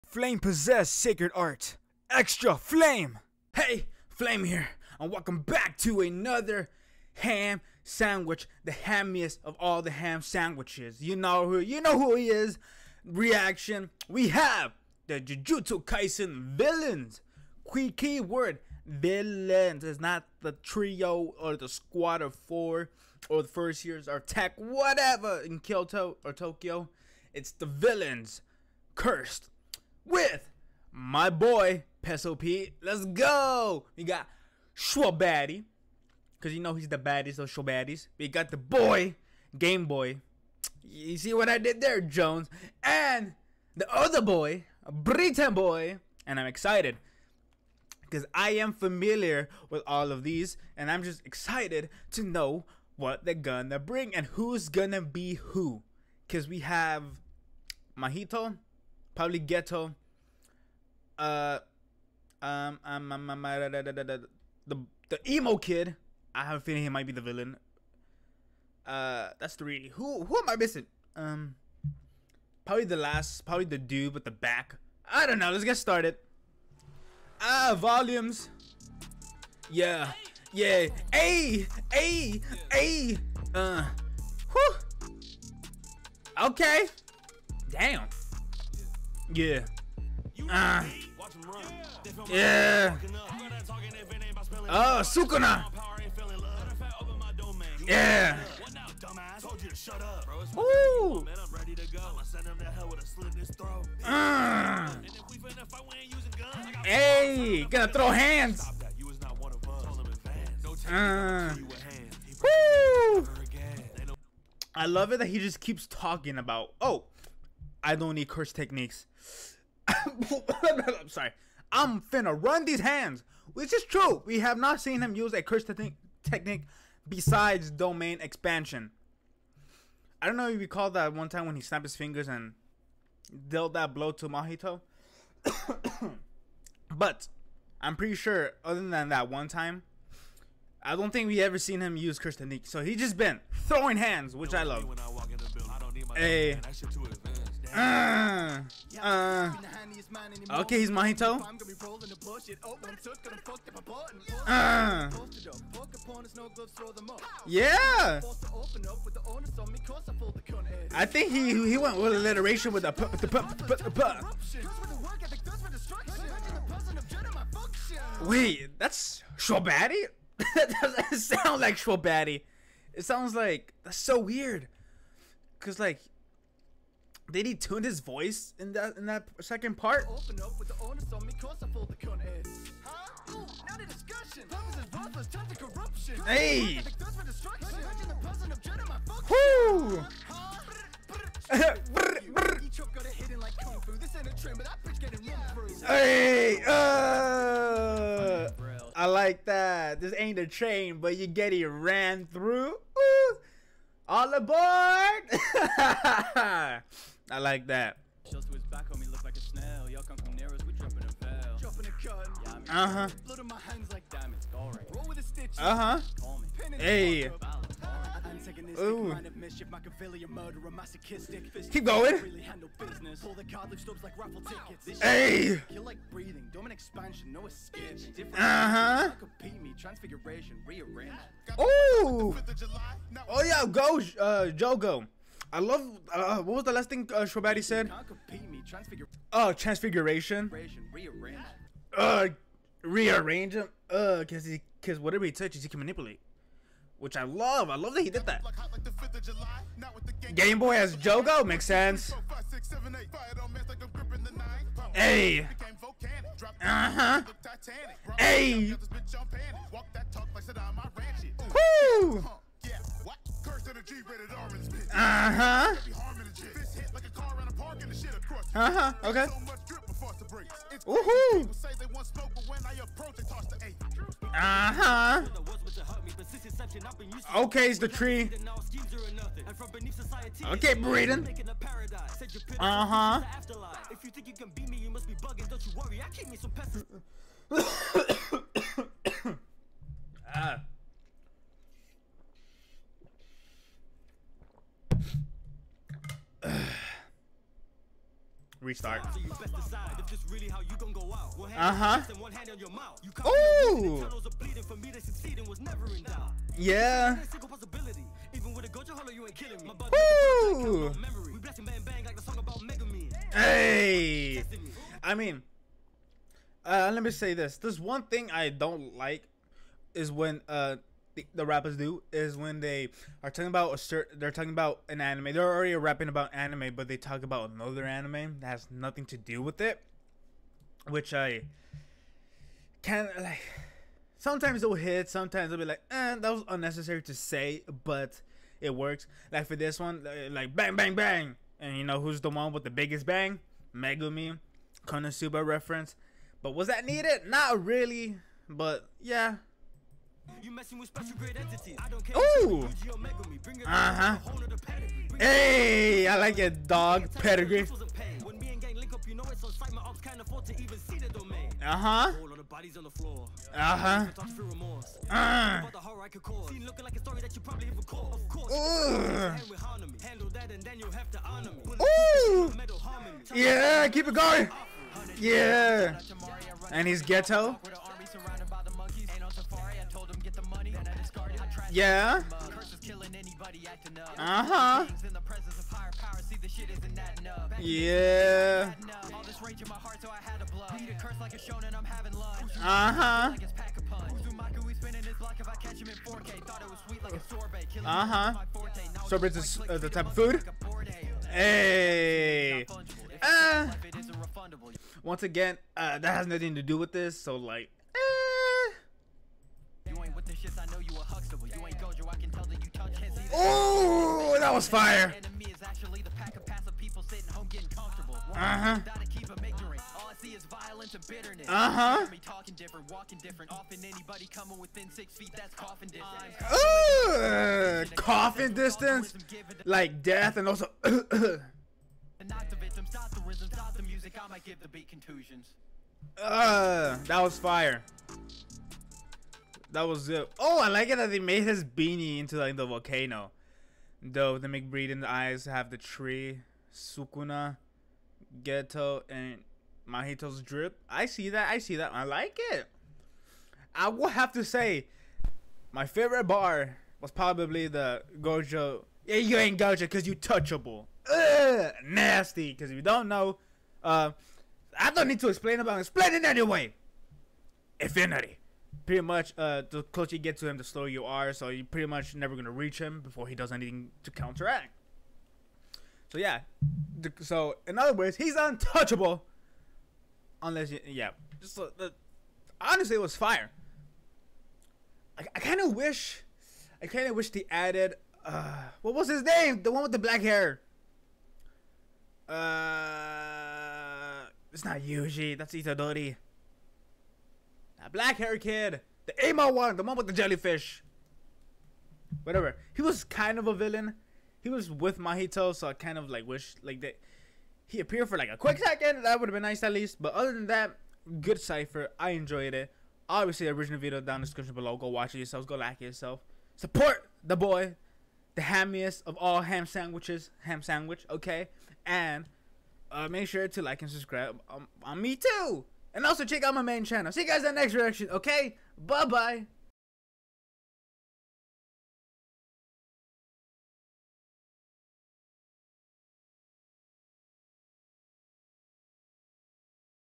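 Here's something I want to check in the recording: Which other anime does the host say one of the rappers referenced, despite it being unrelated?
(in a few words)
Konosuba.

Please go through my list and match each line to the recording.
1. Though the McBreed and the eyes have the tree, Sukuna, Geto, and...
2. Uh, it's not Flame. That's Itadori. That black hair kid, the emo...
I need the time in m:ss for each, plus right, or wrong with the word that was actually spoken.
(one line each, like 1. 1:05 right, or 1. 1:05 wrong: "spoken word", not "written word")
1. 7:24 right
2. 8:12 wrong: "Yuji", not "Flame".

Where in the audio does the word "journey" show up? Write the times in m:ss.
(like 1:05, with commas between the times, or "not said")
not said.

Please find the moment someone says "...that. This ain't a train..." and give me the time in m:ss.
3:19.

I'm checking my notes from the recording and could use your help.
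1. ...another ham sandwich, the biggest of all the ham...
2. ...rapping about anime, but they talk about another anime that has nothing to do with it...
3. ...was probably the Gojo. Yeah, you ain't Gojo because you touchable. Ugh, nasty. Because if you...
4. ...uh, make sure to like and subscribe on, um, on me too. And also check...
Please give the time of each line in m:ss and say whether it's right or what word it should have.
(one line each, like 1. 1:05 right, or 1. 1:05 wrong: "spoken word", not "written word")
1. 0:06 wrong: "hammiest", not "biggest"
2. 5:25 right
3. 7:37 right
4. 8:42 right.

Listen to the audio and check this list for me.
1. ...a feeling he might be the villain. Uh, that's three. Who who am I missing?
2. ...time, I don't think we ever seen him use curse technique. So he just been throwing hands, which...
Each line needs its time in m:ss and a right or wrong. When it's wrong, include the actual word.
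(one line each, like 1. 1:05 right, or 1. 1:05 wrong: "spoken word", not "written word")
1. 1:06 right
2. 2:19 right.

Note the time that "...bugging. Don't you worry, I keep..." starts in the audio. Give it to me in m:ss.
4:45.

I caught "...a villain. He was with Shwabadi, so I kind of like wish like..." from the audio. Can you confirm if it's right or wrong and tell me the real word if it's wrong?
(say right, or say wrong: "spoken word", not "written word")
wrong: "Mahito", not "Shwabadi".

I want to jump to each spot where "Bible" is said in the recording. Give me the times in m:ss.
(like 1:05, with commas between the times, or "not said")
not said.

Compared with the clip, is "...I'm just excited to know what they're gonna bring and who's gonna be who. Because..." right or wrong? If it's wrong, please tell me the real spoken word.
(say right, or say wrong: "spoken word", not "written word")
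right.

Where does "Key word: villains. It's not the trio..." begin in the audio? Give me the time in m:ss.
0:17.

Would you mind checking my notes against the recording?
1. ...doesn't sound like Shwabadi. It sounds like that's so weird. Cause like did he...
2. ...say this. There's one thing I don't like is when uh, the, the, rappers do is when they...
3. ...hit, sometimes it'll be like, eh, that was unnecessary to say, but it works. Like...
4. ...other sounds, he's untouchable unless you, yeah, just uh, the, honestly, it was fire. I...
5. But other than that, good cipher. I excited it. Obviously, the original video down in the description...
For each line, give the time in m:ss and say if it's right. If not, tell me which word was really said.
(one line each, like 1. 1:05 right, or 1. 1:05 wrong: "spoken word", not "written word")
1. 2:50 right
2. 5:17 right
3. 5:34 right
4. 7:57 wrong: "words", not "sounds"
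5. 8:30 wrong: "enjoyed", not "excited".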